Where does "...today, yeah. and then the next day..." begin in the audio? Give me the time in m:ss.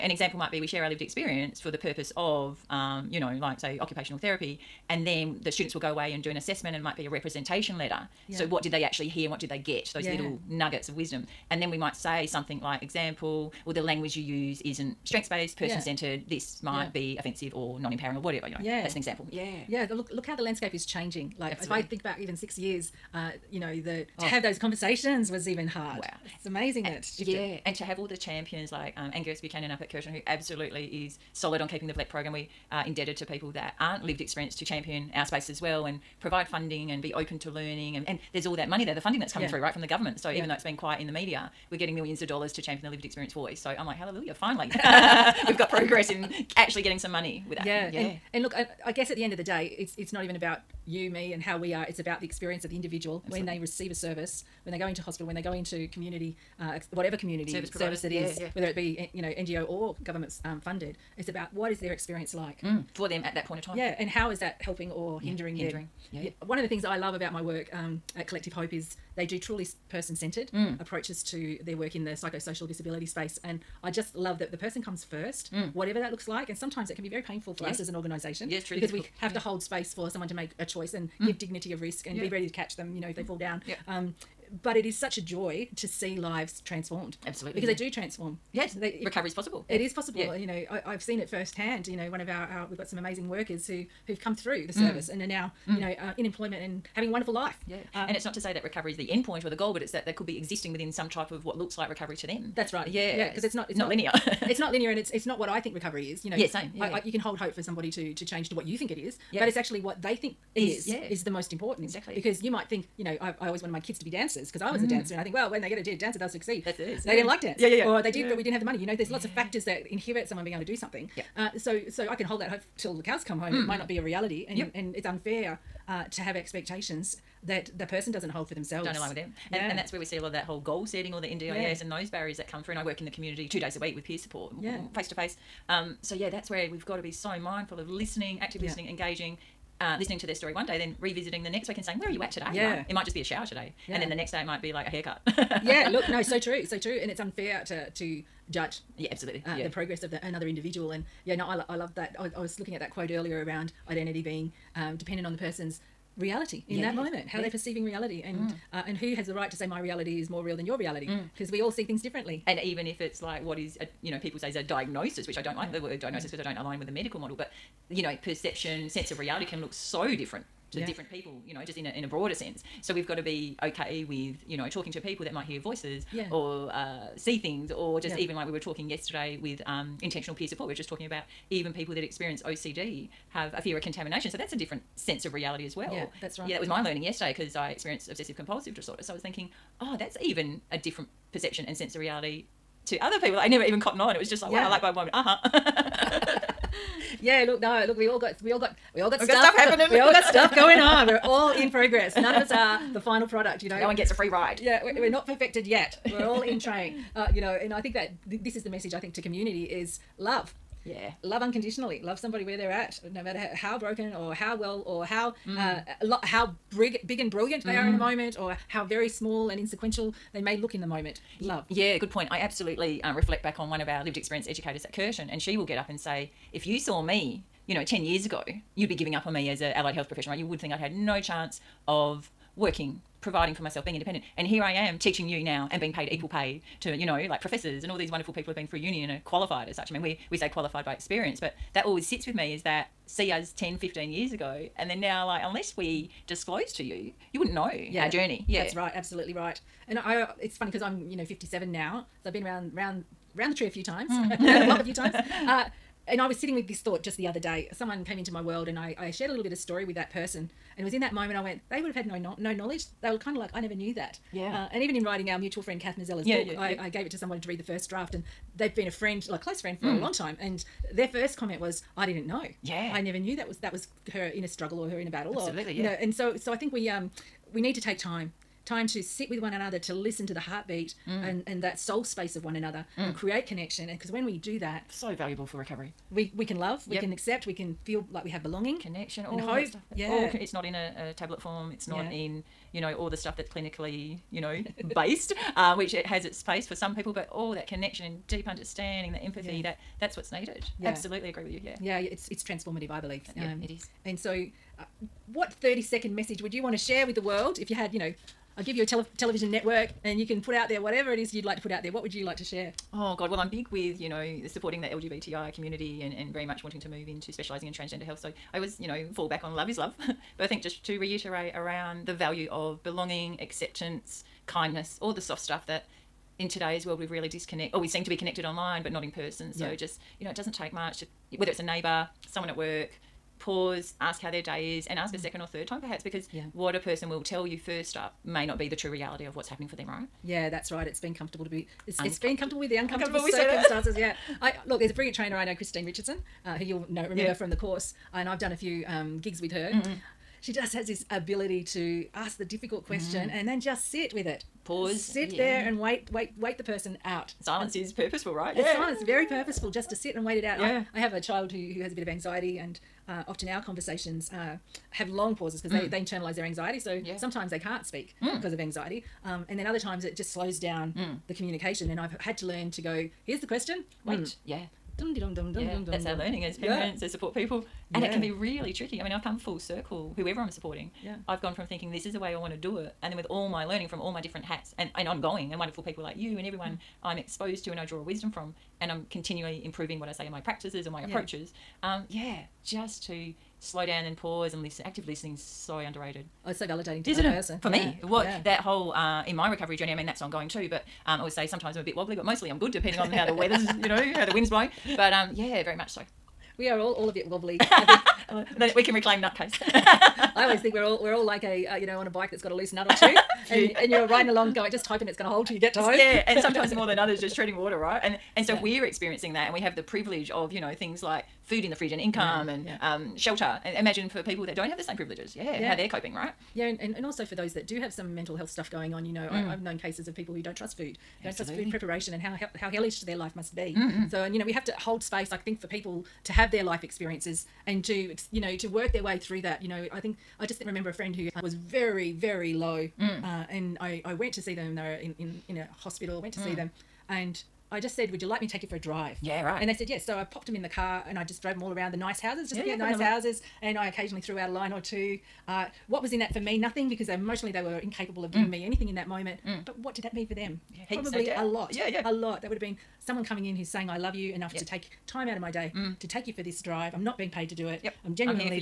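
2:23.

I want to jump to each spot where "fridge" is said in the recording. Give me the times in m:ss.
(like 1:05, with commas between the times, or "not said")
7:01.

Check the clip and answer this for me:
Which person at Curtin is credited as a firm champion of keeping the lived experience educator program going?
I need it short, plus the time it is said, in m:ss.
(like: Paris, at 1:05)
Angus Buchanan, at 0:29.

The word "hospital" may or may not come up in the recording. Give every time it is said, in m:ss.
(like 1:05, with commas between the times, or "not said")
0:55, 7:25.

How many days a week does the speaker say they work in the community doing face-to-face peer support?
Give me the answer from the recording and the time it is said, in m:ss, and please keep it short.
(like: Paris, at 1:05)
2, at 2:13.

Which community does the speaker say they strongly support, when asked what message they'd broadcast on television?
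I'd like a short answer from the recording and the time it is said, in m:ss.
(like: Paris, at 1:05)
LGBTI, at 5:14.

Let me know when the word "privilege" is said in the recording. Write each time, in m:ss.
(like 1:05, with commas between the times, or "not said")
6:59, 7:04.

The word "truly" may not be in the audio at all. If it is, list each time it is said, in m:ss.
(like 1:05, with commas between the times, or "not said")
1:09, 1:18.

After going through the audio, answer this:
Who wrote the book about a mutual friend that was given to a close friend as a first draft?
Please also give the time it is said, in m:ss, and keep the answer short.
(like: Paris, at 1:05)
Kath Mazzella, at 4:25.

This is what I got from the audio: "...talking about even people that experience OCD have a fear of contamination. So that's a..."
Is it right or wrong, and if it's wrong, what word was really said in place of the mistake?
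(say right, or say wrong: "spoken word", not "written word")
right.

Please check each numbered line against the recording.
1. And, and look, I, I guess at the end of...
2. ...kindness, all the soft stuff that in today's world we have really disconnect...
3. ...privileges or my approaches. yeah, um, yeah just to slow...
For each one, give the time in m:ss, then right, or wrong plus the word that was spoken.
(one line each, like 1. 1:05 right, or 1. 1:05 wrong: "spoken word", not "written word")
1. 0:47 right
2. 5:24 right
3. 6:30 wrong: "practices", not "privileges".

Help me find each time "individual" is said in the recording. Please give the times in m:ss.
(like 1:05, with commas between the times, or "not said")
0:52, 2:30.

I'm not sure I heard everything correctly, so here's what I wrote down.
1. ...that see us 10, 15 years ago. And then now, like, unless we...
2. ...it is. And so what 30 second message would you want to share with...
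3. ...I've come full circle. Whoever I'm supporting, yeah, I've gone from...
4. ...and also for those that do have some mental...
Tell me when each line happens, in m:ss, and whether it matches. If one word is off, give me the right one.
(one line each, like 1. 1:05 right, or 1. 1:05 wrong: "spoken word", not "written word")
1. 4:02 right
2. 5:03 right
3. 6:19 right
4. 7:06 right.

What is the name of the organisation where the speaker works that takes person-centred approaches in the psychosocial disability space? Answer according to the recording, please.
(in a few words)
Collective Hope.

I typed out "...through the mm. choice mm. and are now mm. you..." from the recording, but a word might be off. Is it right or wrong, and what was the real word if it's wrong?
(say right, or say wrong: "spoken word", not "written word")
wrong: "service", not "choice".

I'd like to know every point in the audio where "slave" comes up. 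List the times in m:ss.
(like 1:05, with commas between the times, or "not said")
not said.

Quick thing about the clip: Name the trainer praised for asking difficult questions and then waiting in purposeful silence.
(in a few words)
Christine Richardson.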